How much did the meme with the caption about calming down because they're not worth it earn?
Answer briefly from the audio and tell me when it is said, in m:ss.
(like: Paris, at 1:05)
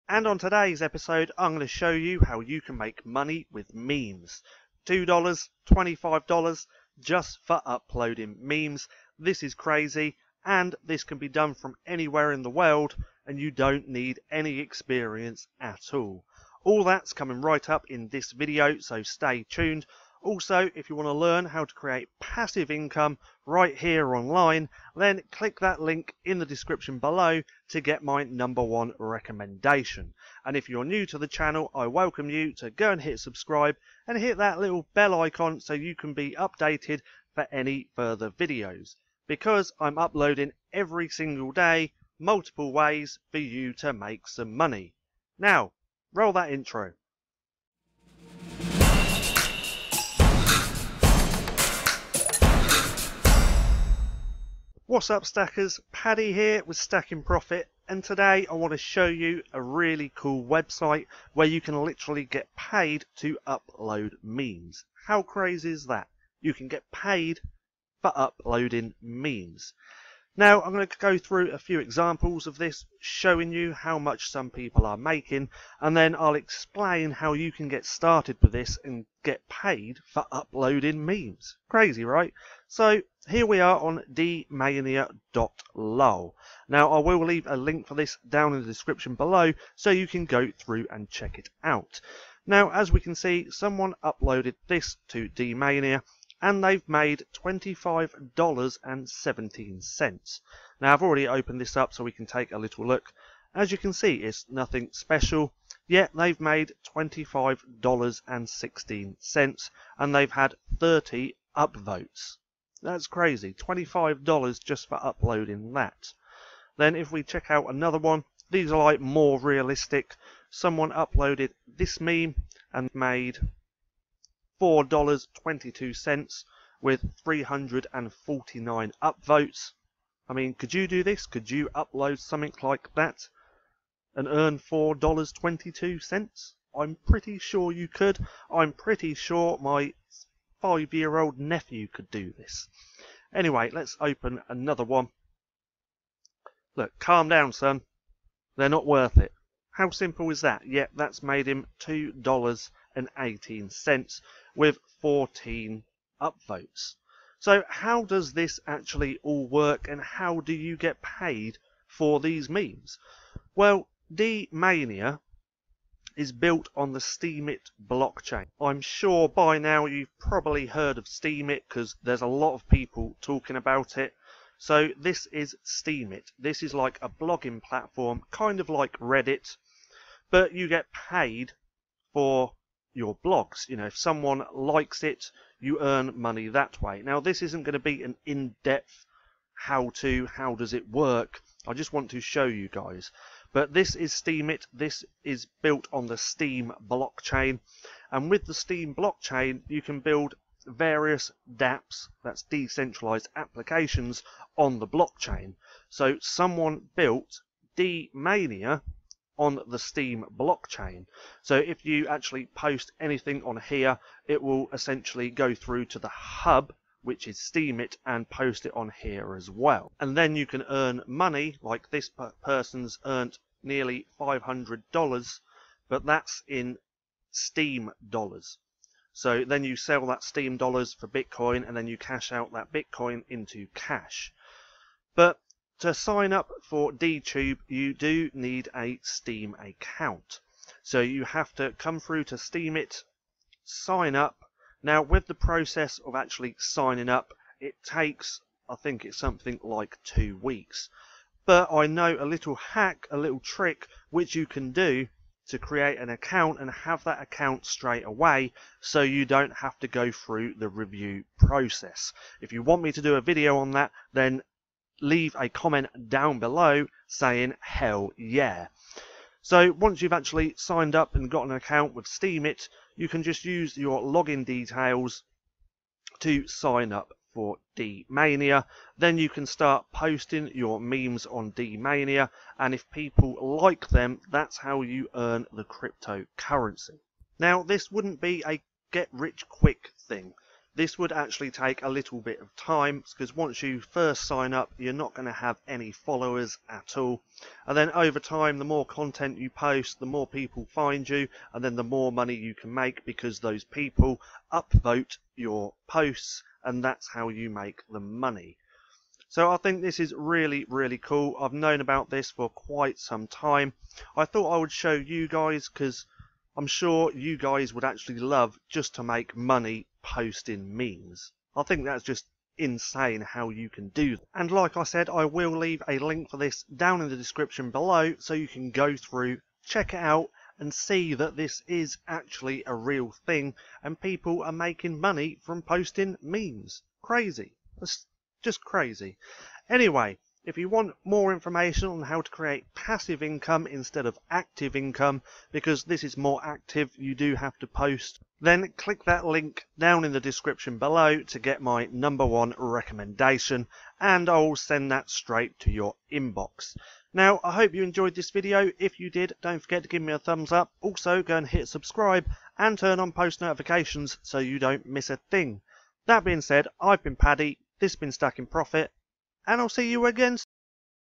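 $2.18, at 2:31.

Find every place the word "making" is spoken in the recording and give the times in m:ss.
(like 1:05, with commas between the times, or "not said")
1:14, 5:34.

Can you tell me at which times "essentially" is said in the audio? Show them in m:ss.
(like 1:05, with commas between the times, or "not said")
3:34.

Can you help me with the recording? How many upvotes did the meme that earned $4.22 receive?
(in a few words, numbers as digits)
349.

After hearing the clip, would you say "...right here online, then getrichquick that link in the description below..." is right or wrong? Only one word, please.
wrong.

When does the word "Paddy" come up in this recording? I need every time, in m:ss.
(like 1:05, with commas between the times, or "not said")
0:55, 6:07.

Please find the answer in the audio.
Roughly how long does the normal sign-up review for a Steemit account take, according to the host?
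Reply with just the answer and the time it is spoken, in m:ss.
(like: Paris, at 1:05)
two weeks, at 4:10.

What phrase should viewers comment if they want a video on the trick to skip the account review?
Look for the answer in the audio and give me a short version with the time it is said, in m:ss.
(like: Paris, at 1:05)
hell yeah, at 4:27.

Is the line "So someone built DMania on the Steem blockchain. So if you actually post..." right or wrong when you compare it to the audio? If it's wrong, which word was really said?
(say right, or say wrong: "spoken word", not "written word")
right.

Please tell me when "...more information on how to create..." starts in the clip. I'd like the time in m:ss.
5:41.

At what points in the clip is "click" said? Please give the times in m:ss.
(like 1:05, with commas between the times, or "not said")
0:25, 5:48.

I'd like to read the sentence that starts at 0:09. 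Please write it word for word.
This is crazy and this can be done from anywhere in the world and you don't need any experience at all.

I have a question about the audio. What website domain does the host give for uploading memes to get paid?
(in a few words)
dmania.lol.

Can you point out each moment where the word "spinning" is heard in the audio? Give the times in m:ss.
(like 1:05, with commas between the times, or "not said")
not said.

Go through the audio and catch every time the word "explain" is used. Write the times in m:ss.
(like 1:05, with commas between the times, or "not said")
1:16.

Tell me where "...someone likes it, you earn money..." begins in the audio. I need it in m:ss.
3:03.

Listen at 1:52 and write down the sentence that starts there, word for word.
That's crazy, $25 just for uploading that.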